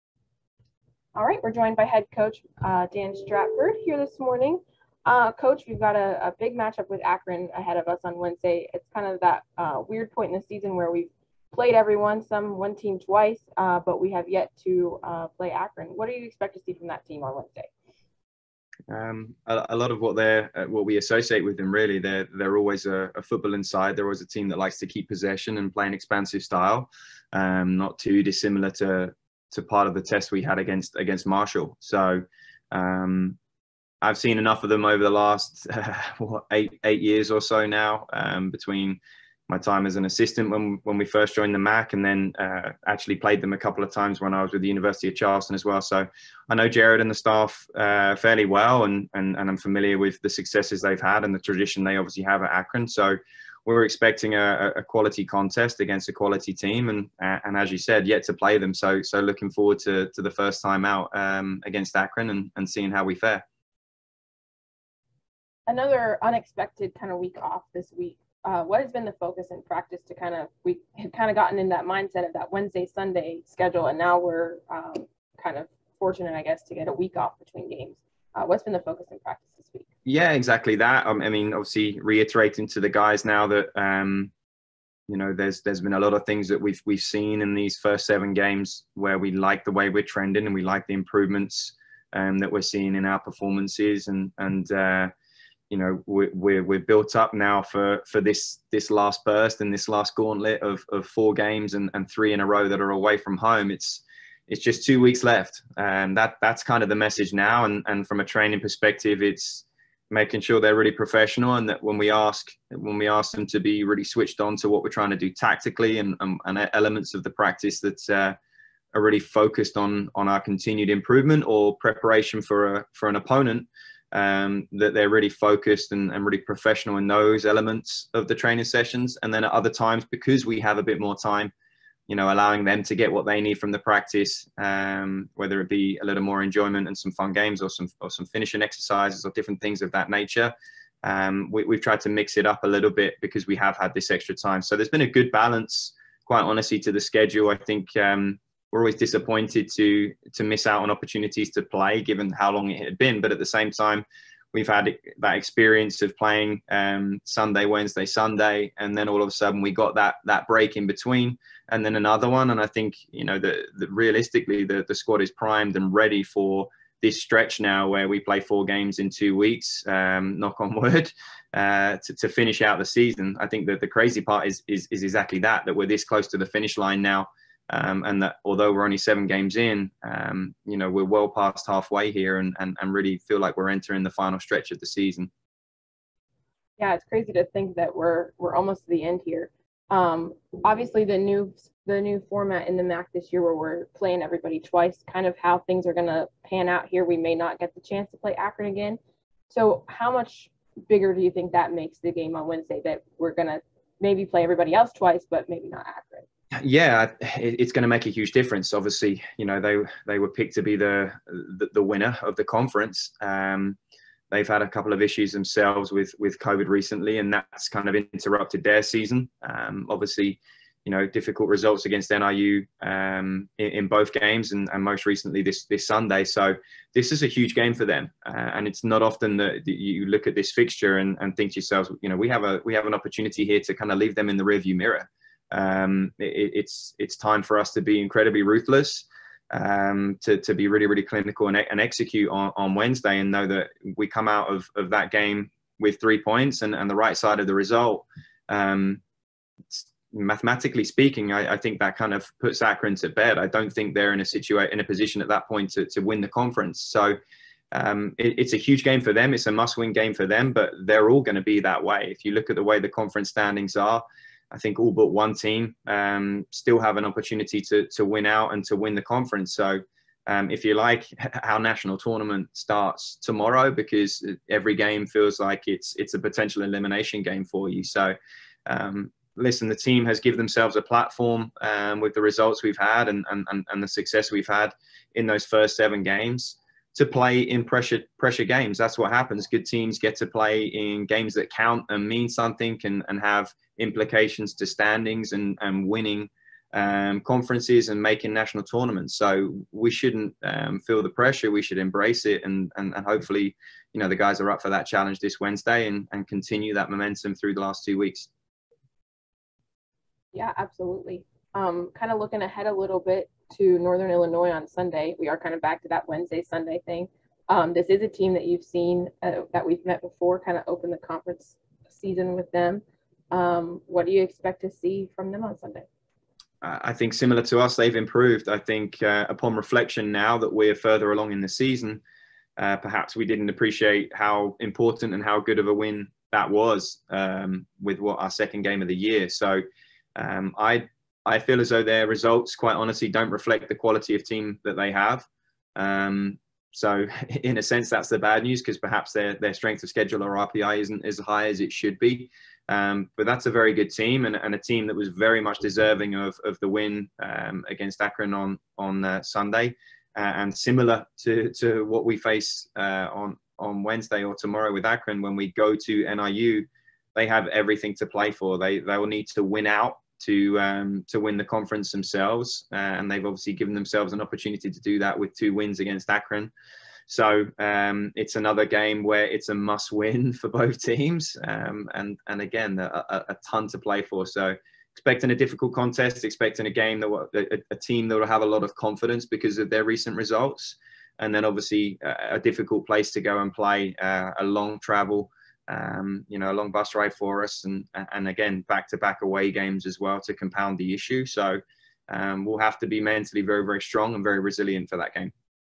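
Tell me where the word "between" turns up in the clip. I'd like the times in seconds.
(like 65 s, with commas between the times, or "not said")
38 s, 77 s, 160 s.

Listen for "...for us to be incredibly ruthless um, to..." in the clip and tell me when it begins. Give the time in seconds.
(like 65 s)
237 s.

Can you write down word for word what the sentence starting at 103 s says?
It's it's just two weeks left, and um, that that's kind of the message now.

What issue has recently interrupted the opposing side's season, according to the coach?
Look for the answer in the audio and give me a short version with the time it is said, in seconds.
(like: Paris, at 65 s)
COVID, at 216 s.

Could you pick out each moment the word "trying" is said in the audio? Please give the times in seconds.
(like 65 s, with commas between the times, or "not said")
114 s.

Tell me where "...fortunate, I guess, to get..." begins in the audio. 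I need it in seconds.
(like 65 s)
75 s.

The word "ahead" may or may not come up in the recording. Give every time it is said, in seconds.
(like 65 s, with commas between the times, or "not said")
7 s, 312 s.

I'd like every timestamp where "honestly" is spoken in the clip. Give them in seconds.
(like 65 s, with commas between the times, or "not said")
146 s, 342 s.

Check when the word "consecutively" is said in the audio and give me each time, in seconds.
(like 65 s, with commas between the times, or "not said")
not said.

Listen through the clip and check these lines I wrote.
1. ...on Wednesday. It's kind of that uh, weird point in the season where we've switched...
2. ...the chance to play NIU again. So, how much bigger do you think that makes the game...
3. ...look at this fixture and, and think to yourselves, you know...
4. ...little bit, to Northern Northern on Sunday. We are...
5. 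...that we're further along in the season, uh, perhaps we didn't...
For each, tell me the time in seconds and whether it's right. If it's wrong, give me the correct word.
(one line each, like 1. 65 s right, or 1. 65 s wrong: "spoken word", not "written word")
1. 8 s wrong: "played", not "switched"
2. 197 s wrong: "Akron", not "NIU"
3. 230 s right
4. 312 s wrong: "Illinois", not "Northern"
5. 330 s right.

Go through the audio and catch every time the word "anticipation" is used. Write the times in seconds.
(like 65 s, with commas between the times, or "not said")
not said.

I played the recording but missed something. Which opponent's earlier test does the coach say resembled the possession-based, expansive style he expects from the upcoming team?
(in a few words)
Marshall.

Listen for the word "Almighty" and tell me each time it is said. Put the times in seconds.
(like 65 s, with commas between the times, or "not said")
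not said.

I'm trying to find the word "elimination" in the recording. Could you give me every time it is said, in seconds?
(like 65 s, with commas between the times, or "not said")
276 s.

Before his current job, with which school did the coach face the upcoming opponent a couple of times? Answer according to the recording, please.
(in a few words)
University of Charleston.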